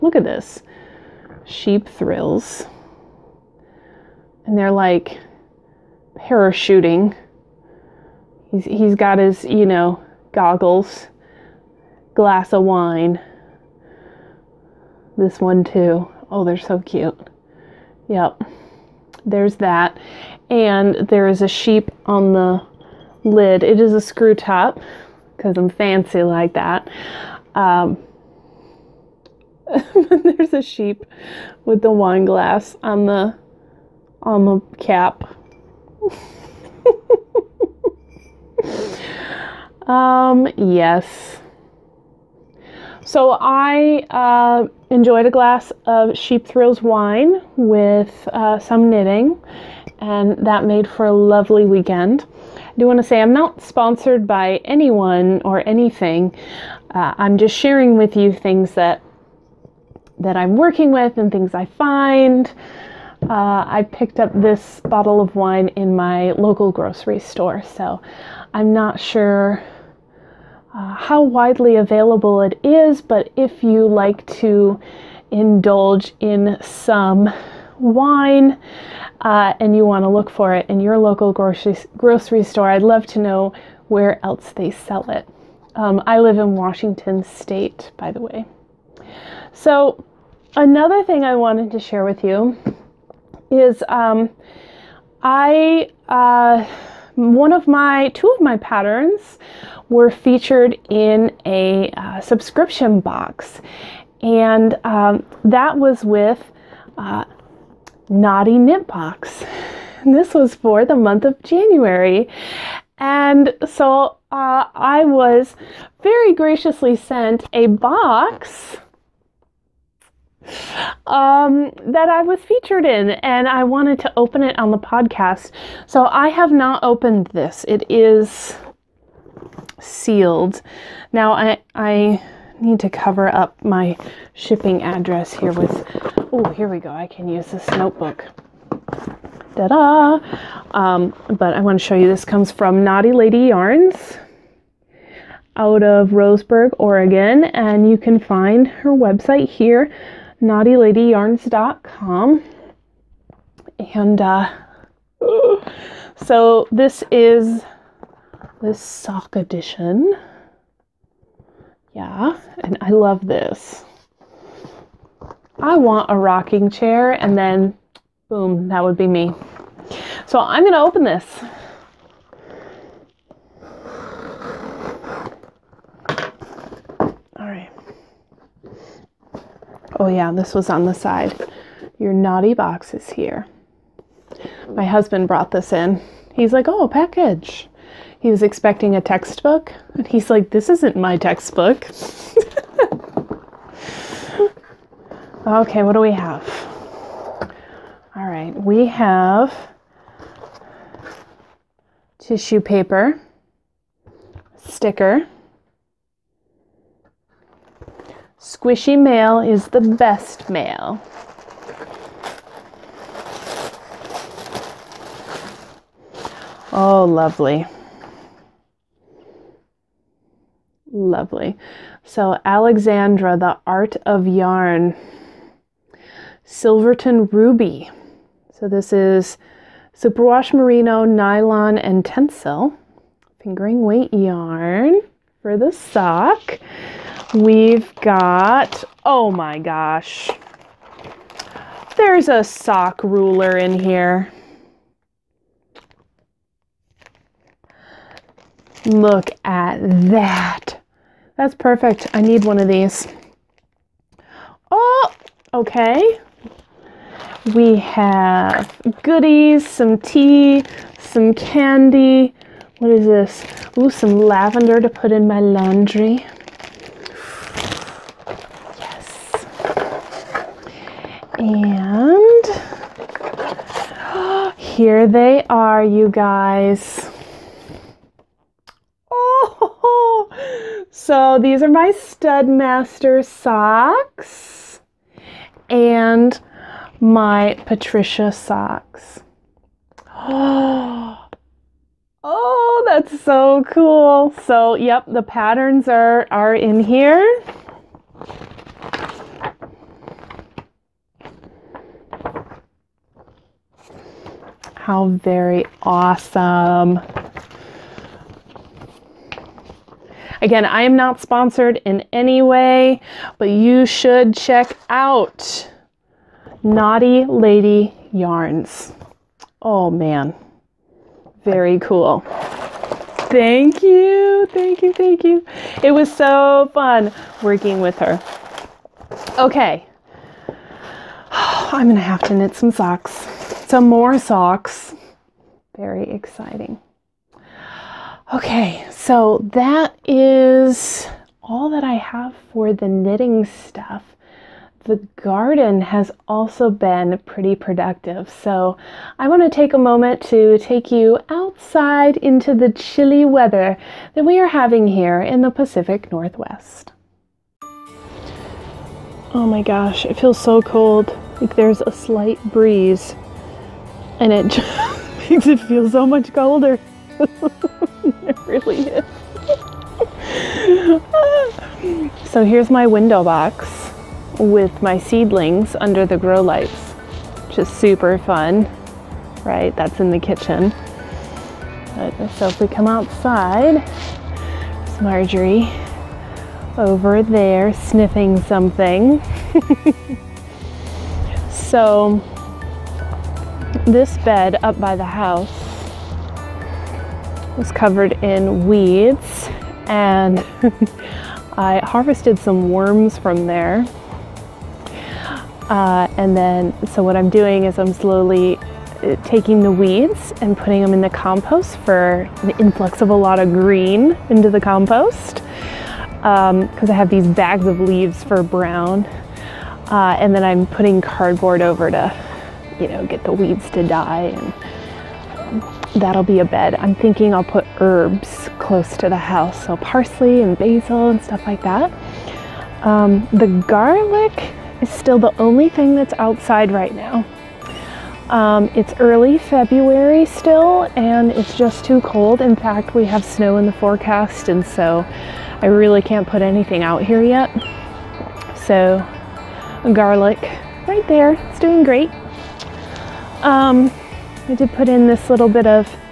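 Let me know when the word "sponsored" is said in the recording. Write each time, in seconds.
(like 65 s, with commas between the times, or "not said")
53 s, 311 s.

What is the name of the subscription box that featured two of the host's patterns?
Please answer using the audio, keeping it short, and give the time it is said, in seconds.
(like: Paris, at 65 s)
Knotty Knit Box, at 108 s.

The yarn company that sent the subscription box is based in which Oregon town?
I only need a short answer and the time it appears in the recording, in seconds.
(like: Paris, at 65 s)
Roseburg, at 146 s.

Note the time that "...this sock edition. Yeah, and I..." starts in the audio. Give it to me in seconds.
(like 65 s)
158 s.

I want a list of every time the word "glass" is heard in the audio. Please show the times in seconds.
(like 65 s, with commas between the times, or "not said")
12 s, 32 s, 45 s.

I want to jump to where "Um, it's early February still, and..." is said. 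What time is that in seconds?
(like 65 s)
438 s.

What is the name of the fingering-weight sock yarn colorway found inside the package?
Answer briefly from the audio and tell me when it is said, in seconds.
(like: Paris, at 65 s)
Silverton Ruby, at 226 s.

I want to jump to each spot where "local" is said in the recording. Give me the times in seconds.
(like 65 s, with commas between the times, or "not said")
66 s, 80 s.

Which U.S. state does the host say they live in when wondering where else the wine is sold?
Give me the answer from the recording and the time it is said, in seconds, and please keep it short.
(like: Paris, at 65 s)
Washington State, at 86 s.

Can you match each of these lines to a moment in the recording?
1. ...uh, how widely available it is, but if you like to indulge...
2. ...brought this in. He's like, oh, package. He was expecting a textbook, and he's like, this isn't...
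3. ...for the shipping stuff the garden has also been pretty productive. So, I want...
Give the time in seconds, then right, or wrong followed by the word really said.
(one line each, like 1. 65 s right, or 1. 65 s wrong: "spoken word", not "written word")
1. 70 s right
2. 185 s right
3. 342 s wrong: "knitting", not "shipping".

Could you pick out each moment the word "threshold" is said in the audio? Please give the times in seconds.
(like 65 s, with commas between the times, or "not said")
not said.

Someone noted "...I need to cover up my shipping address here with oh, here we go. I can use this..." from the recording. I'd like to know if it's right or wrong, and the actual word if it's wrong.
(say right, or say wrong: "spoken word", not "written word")
right.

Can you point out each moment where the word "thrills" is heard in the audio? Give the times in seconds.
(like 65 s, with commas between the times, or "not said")
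1 s, 46 s.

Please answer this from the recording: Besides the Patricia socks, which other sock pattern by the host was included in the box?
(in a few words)
Studmaster socks.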